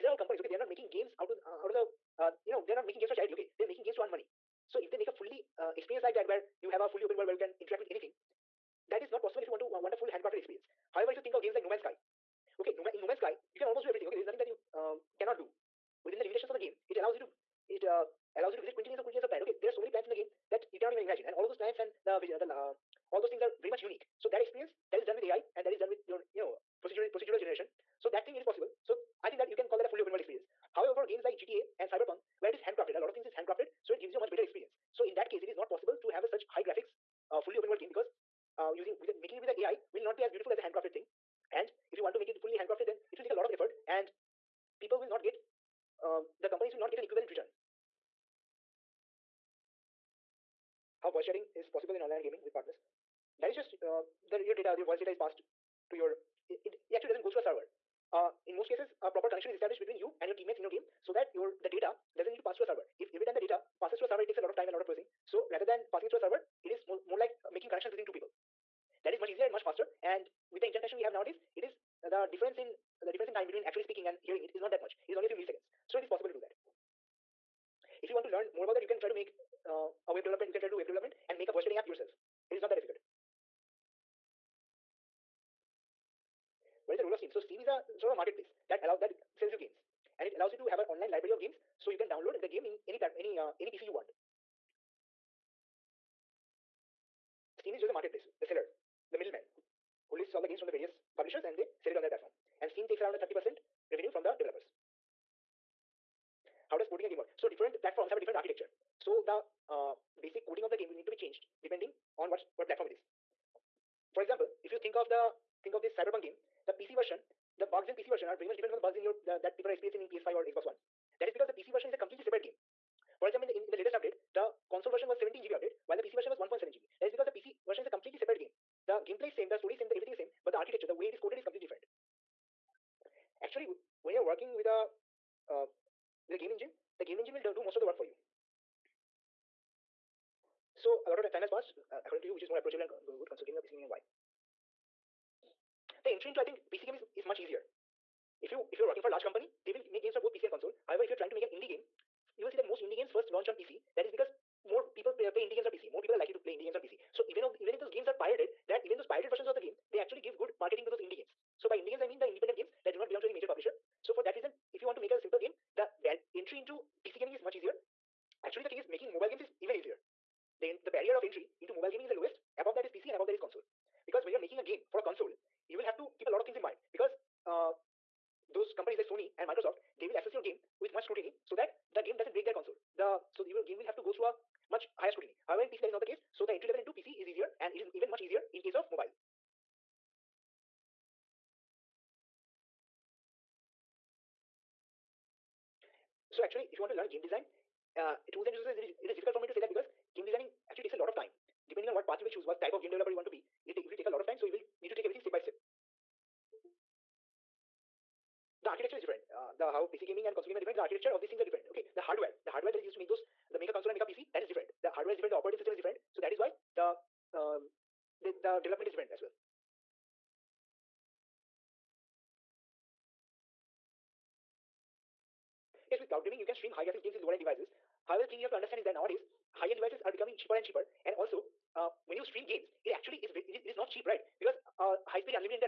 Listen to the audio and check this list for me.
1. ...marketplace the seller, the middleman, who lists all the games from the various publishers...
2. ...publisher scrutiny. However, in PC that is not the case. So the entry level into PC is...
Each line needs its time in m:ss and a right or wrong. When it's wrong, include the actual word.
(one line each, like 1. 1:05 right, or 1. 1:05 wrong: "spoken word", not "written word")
1. 1:37 right
2. 3:04 wrong: "higher", not "publisher".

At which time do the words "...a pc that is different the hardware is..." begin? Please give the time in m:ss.
3:34.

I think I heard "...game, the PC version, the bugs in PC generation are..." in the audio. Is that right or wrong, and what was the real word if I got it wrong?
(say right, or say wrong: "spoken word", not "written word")
wrong: "version", not "generation".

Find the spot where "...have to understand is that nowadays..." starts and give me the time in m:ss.
3:48.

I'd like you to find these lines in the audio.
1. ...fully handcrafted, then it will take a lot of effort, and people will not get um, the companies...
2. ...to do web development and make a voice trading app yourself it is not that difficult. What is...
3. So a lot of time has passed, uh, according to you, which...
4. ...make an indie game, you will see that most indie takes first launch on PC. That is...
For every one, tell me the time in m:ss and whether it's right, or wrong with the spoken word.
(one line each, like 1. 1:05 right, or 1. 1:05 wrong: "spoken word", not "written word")
1. 0:42 right
2. 1:20 right
3. 2:20 right
4. 2:31 wrong: "games", not "takes".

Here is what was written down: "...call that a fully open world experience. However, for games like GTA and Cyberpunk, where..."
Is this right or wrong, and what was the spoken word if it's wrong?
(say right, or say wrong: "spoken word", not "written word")
right.